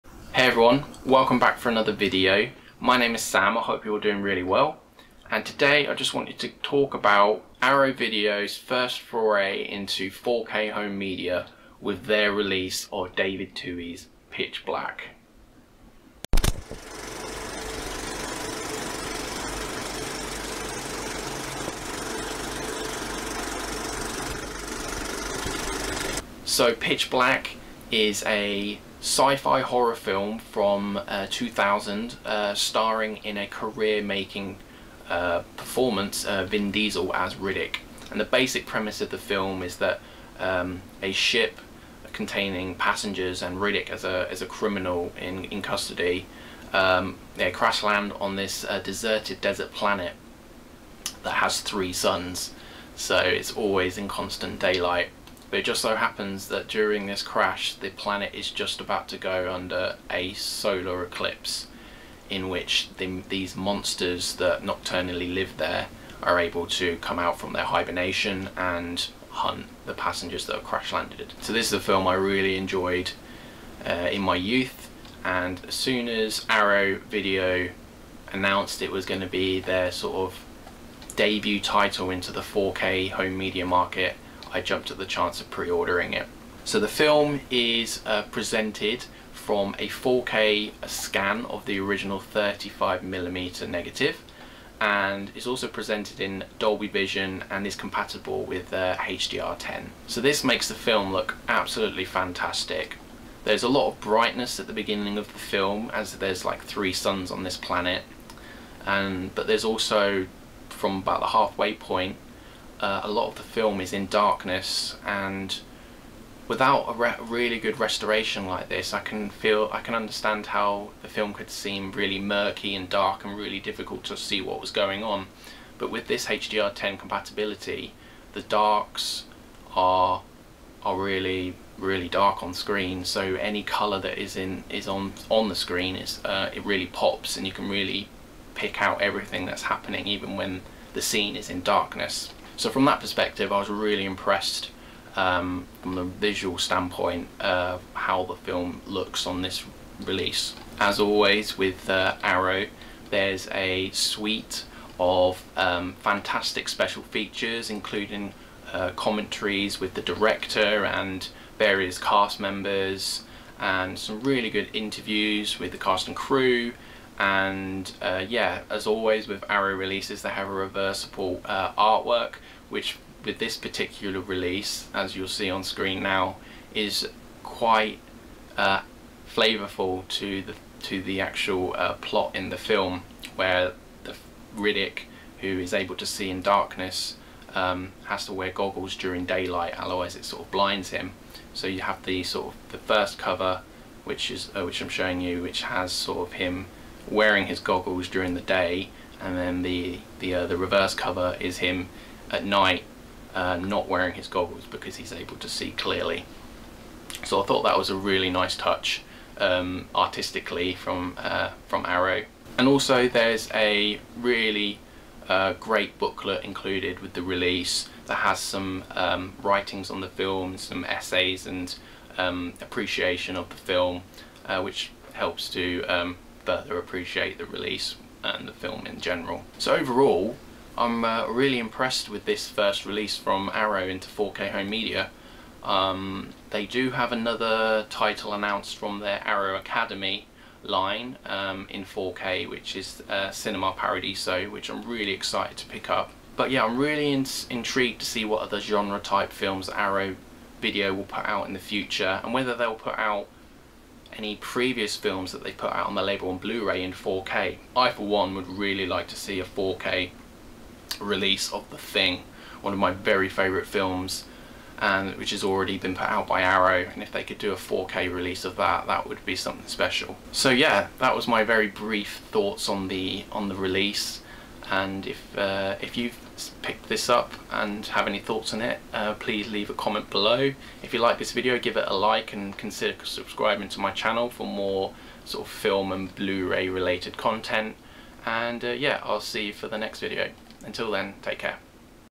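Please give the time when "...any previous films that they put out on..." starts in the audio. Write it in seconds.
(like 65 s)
254 s.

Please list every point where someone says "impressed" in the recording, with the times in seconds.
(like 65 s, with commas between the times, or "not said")
144 s, 231 s.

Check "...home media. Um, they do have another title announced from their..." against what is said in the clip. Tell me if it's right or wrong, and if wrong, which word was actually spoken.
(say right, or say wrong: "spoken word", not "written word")
right.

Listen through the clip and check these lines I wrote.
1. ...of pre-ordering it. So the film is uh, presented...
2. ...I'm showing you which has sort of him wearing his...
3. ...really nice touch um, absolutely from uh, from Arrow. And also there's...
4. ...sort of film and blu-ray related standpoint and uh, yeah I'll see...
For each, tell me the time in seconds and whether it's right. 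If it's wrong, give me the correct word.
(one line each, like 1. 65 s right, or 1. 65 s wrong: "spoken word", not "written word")
1. 85 s right
2. 194 s right
3. 207 s wrong: "artistically", not "absolutely"
4. 285 s wrong: "content", not "standpoint".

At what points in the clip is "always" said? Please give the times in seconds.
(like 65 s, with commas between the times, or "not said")
53 s, 150 s, 168 s.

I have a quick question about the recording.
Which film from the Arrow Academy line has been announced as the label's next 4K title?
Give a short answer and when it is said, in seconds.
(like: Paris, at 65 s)
Cinema Paradiso, at 243 s.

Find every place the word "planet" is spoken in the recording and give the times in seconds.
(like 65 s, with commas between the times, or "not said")
49 s, 57 s, 107 s.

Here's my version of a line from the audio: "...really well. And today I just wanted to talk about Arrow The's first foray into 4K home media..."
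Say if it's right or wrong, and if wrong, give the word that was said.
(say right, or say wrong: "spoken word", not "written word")
wrong: "Video", not "The".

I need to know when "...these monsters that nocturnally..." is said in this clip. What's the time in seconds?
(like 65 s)
63 s.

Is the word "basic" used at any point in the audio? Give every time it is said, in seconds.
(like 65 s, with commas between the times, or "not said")
38 s.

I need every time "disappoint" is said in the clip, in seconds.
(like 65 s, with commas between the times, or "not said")
not said.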